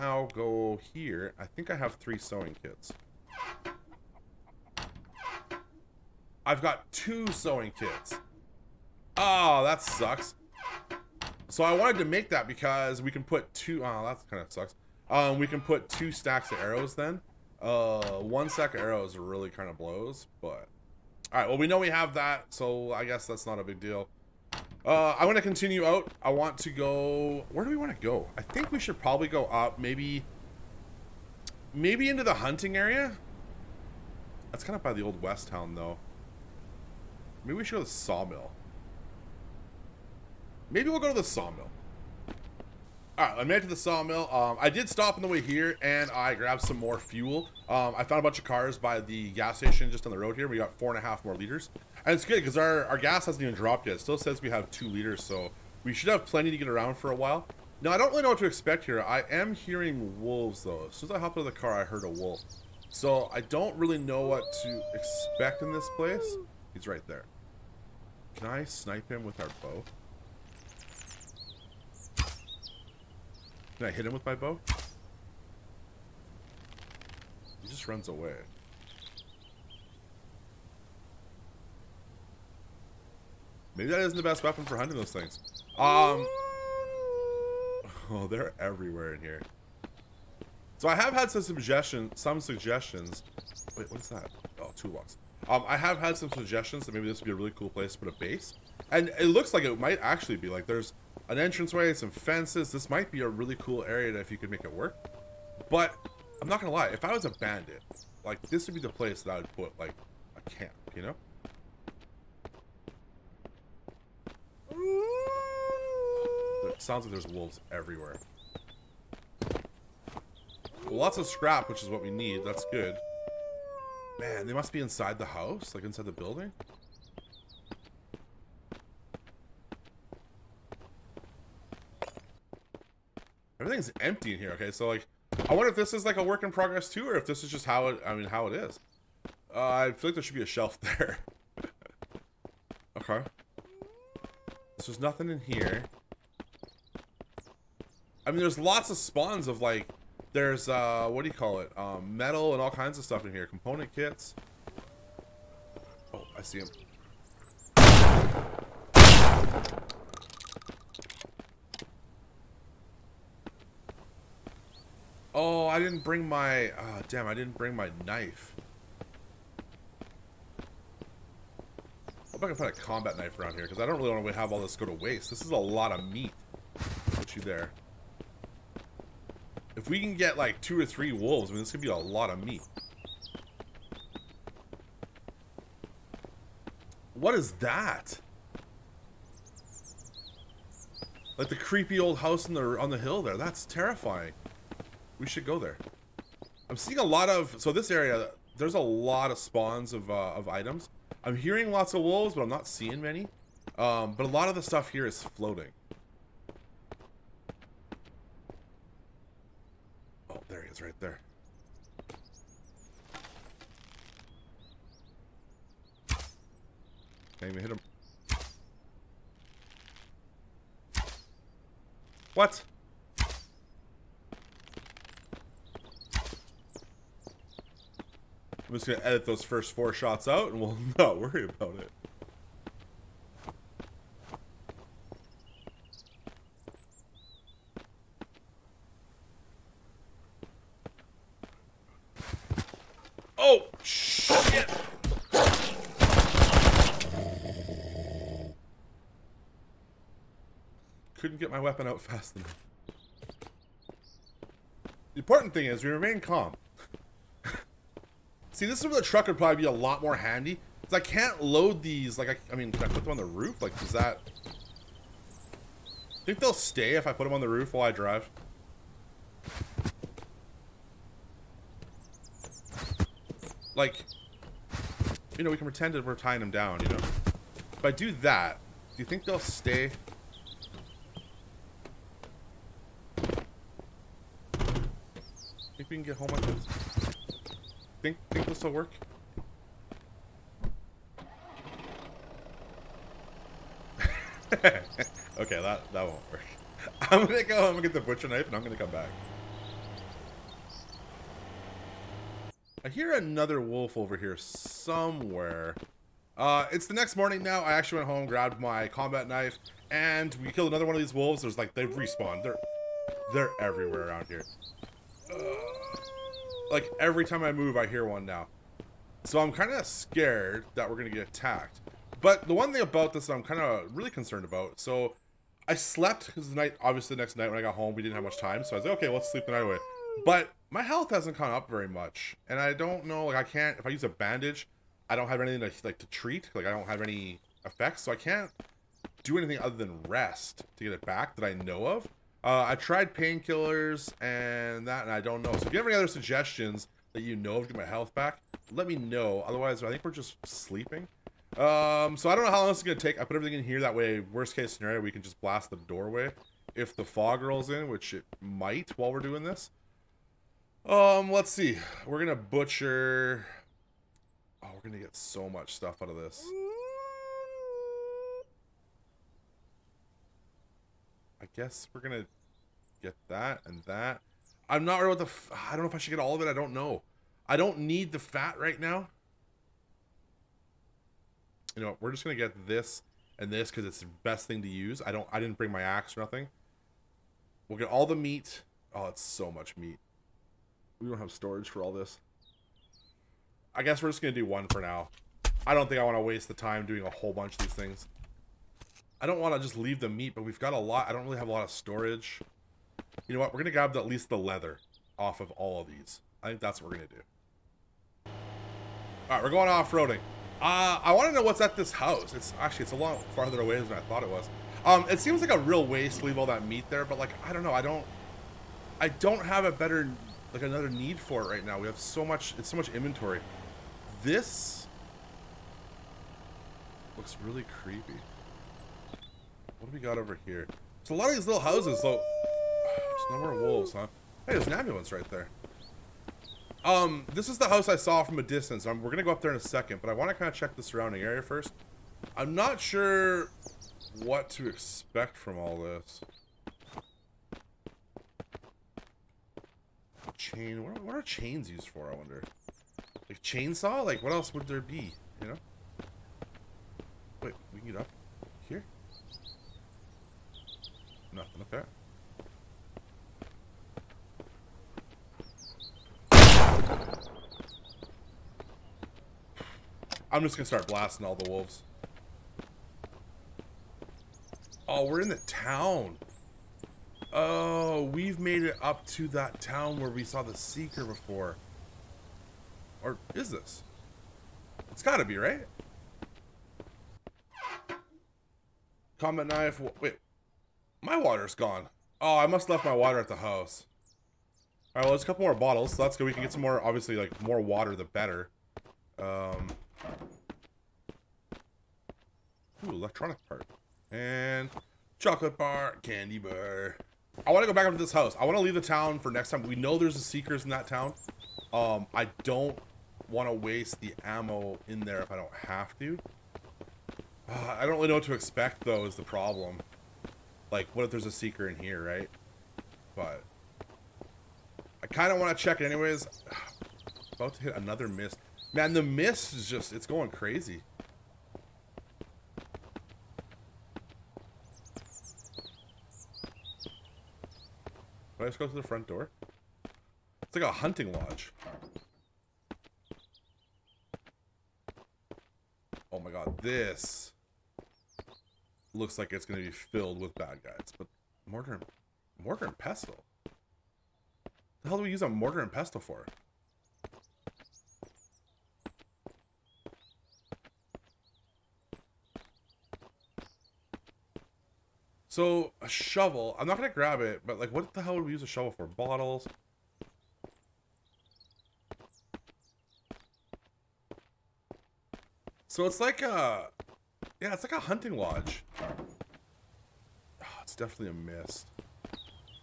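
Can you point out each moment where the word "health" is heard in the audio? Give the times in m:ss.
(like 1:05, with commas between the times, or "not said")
5:30, 5:47.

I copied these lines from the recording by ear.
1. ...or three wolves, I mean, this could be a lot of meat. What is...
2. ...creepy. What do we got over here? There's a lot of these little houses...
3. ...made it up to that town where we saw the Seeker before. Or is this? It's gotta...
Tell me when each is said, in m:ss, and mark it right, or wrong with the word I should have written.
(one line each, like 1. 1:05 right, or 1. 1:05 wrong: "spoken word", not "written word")
1. 3:00 right
2. 7:07 right
3. 7:58 right.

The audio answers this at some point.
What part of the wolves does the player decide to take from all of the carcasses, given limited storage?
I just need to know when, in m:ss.
6:44.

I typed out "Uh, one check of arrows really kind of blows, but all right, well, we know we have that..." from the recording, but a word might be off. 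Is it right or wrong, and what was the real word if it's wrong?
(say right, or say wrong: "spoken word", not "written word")
wrong: "stack", not "check".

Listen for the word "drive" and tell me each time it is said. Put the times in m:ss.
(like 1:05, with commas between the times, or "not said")
4:27.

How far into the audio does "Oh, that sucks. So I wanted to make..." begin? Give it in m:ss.
0:09.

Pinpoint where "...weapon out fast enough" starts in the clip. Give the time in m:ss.
4:11.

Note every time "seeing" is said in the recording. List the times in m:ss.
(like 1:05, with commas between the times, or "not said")
3:16, 3:22.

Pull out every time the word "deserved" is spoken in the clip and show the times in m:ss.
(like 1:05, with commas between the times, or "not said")
not said.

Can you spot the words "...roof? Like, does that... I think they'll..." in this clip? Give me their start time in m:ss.
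4:23.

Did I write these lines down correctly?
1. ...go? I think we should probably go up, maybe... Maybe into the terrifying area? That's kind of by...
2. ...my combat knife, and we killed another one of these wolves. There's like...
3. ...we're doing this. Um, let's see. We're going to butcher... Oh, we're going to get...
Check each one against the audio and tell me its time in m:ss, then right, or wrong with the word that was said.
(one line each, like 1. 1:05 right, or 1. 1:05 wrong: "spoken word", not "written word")
1. 0:27 wrong: "hunting", not "terrifying"
2. 5:08 right
3. 5:59 right.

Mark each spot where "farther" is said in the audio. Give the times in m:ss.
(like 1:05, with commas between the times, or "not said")
6:53.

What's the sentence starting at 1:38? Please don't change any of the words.
And it looks like it might actually be.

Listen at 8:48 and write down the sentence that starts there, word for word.
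Man, the mist is just, it's going crazy.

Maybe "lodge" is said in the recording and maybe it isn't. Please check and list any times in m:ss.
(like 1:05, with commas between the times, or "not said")
9:01, 9:38.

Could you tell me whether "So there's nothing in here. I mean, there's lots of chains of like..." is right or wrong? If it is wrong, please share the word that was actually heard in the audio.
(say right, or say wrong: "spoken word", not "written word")
wrong: "spawns", not "chains".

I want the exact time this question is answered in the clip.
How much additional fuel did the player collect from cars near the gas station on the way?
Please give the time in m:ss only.
0:50.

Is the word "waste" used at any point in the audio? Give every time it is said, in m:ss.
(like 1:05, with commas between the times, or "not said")
2:54, 6:36, 6:55, 8:33.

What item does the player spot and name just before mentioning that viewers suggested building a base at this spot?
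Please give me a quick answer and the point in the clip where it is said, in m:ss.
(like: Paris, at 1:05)
Toolbox, at 1:34.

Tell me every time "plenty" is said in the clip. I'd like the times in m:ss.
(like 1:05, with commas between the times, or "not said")
0:56.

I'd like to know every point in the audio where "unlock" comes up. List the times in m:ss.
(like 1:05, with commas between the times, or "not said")
not said.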